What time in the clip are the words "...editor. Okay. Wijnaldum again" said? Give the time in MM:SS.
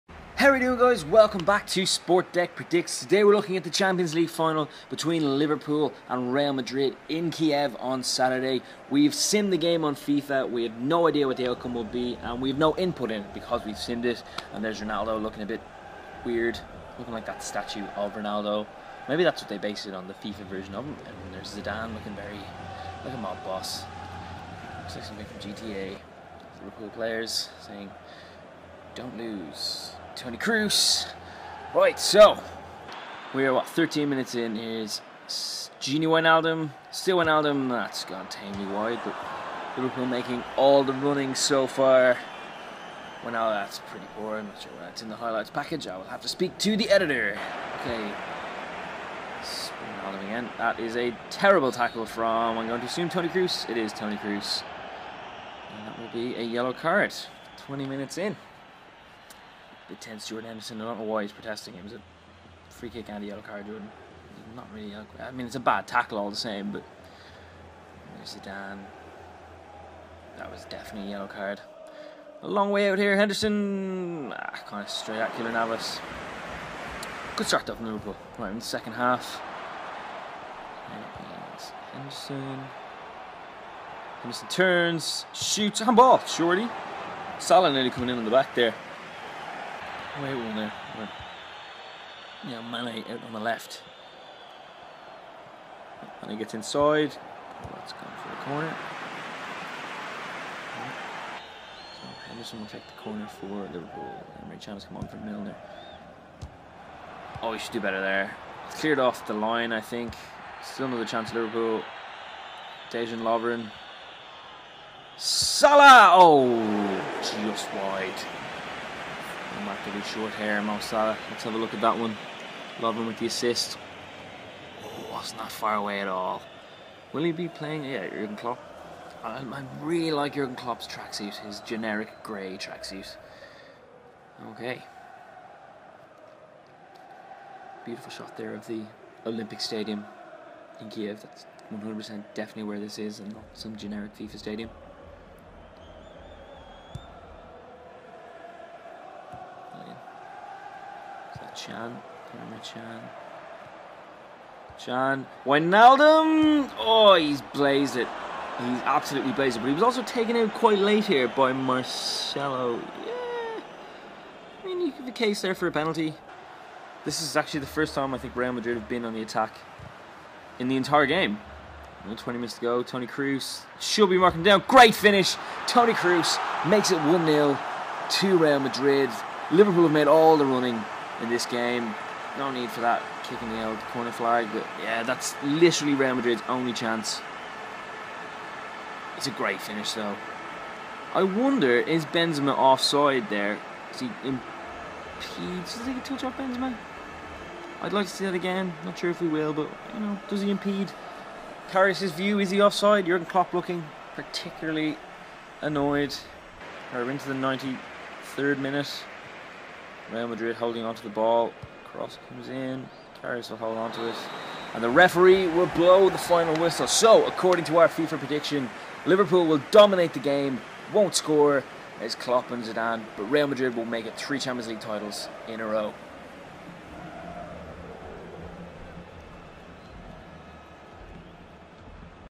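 00:46.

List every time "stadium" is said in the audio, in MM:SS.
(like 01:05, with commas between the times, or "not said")
02:19, 02:24.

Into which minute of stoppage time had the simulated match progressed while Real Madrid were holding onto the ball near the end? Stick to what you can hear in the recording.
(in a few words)
93rd minute.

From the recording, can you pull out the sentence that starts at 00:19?
Maybe that's what they based it on, the FIFA version of him.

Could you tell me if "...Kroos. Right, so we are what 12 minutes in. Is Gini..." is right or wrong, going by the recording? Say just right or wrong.
wrong.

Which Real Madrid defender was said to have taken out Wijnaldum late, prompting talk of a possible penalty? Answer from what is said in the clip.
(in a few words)
Marcelo.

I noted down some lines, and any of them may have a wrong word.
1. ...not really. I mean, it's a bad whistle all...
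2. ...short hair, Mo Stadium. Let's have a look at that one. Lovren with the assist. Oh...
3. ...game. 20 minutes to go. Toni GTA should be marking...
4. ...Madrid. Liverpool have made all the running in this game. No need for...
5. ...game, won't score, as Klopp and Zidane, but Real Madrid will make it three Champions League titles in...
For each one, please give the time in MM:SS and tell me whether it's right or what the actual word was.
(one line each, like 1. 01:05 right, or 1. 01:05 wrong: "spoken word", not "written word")
1. 01:04 wrong: "tackle", not "whistle"
2. 02:00 wrong: "Salah", not "Stadium"
3. 02:51 wrong: "Kroos", not "GTA"
4. 02:58 right
5. 03:40 right.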